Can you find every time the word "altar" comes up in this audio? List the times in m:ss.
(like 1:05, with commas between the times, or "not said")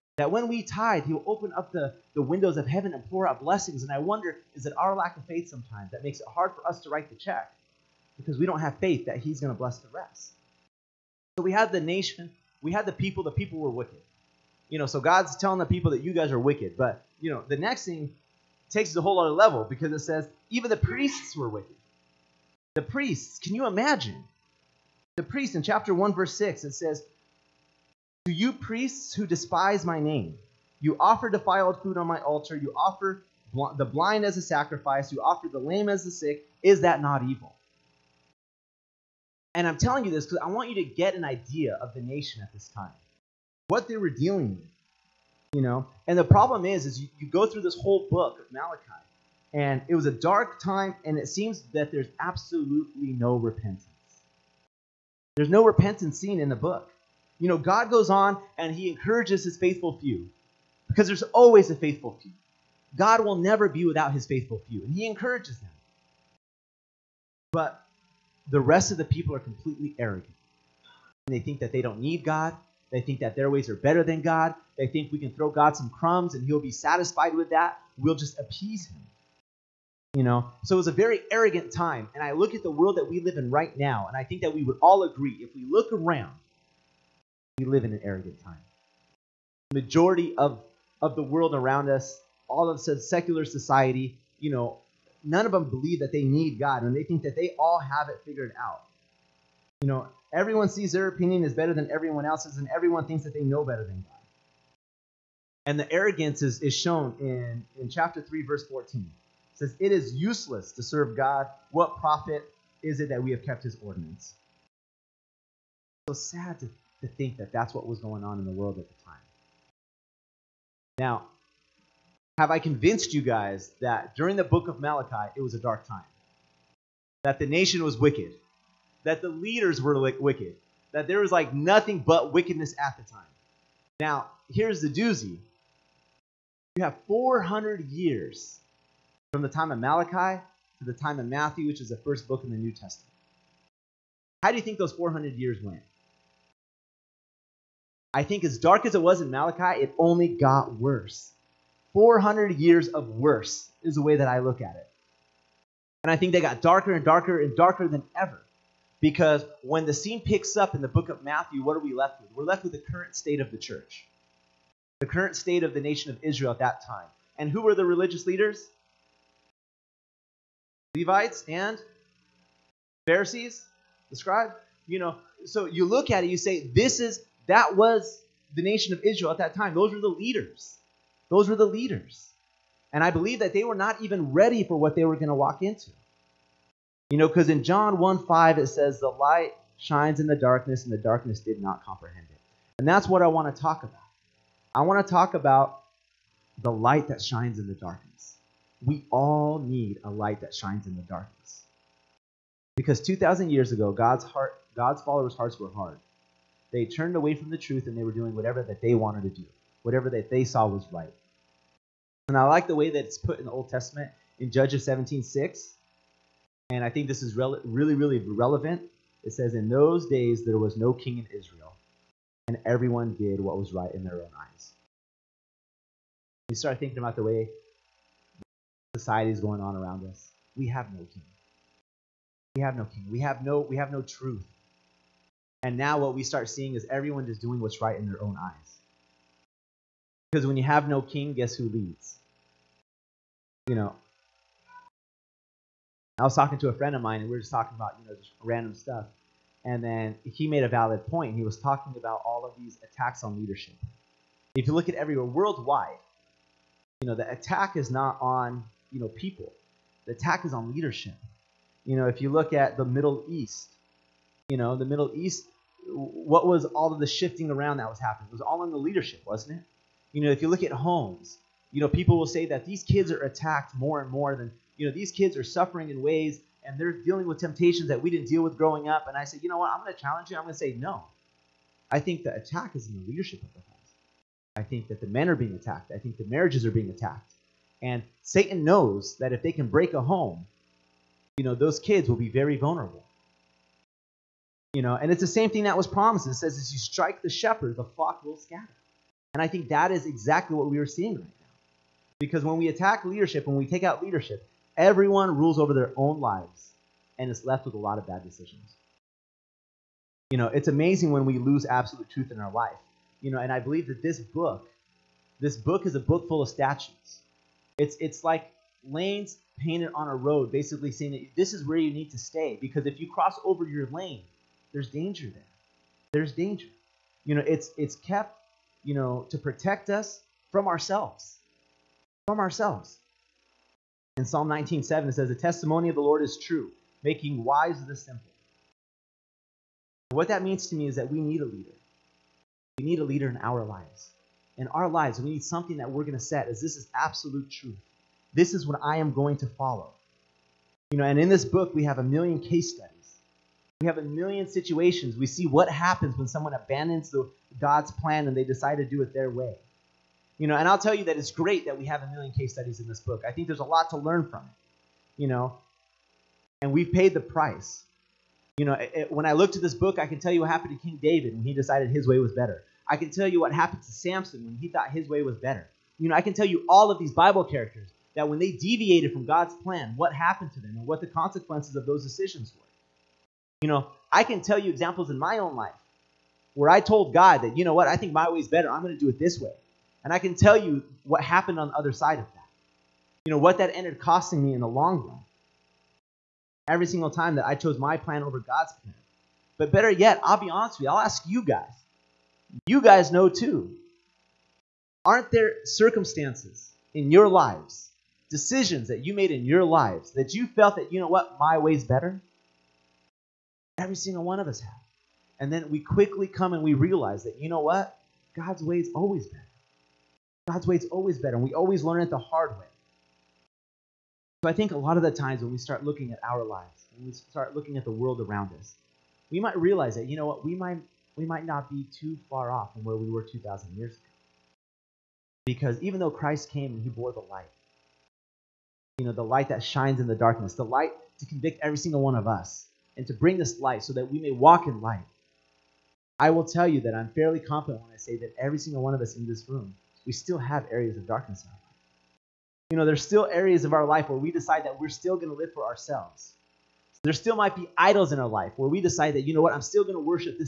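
0:32.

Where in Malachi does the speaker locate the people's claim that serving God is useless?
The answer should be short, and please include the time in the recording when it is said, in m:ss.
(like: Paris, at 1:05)
Chapter 3, verse 14, at 1:47.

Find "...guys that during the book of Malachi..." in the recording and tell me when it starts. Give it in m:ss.
2:03.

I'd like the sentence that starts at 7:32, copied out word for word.
You know, there's still areas of our life where we decide that we're still going to live for ourselves.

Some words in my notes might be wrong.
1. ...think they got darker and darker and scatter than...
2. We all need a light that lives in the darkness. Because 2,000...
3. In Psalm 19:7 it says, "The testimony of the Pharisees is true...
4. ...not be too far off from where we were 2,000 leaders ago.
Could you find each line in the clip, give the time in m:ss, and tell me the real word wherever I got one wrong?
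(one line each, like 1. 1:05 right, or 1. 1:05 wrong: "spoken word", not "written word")
1. 2:36 wrong: "darker", not "scatter"
2. 3:18 wrong: "shines", not "lives"
3. 5:34 wrong: "Lord", not "Pharisees"
4. 7:11 wrong: "years", not "leaders".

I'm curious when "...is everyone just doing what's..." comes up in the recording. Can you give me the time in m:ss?
3:56.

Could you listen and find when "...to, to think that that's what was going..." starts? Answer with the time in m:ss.
1:56.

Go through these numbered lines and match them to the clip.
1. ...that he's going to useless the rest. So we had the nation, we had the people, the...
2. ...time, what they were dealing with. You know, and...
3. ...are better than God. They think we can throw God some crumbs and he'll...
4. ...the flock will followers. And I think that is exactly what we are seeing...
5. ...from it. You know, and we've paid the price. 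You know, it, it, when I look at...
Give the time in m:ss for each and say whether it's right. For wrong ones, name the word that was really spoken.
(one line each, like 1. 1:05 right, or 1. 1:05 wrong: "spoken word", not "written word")
1. 0:09 wrong: "bless", not "useless"
2. 0:42 right
3. 1:13 right
4. 4:57 wrong: "scatter", not "followers"
5. 6:04 right.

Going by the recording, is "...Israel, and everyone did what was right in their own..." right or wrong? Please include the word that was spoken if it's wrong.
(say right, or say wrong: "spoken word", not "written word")
right.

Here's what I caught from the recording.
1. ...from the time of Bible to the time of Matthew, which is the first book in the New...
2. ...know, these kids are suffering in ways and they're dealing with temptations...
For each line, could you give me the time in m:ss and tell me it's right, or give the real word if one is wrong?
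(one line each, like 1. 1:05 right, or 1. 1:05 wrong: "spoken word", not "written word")
1. 2:19 wrong: "Malachi", not "Bible"
2. 4:34 right.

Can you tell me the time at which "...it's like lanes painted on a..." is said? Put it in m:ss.
5:17.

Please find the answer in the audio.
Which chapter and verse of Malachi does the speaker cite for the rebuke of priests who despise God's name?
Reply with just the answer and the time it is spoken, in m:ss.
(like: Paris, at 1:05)
Chapter 1, verse 6, at 0:25.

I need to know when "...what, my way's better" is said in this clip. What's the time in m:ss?
6:51.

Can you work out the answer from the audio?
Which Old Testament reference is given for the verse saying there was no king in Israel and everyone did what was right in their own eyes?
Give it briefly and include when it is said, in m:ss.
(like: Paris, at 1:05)
Judges 17:6, at 3:34.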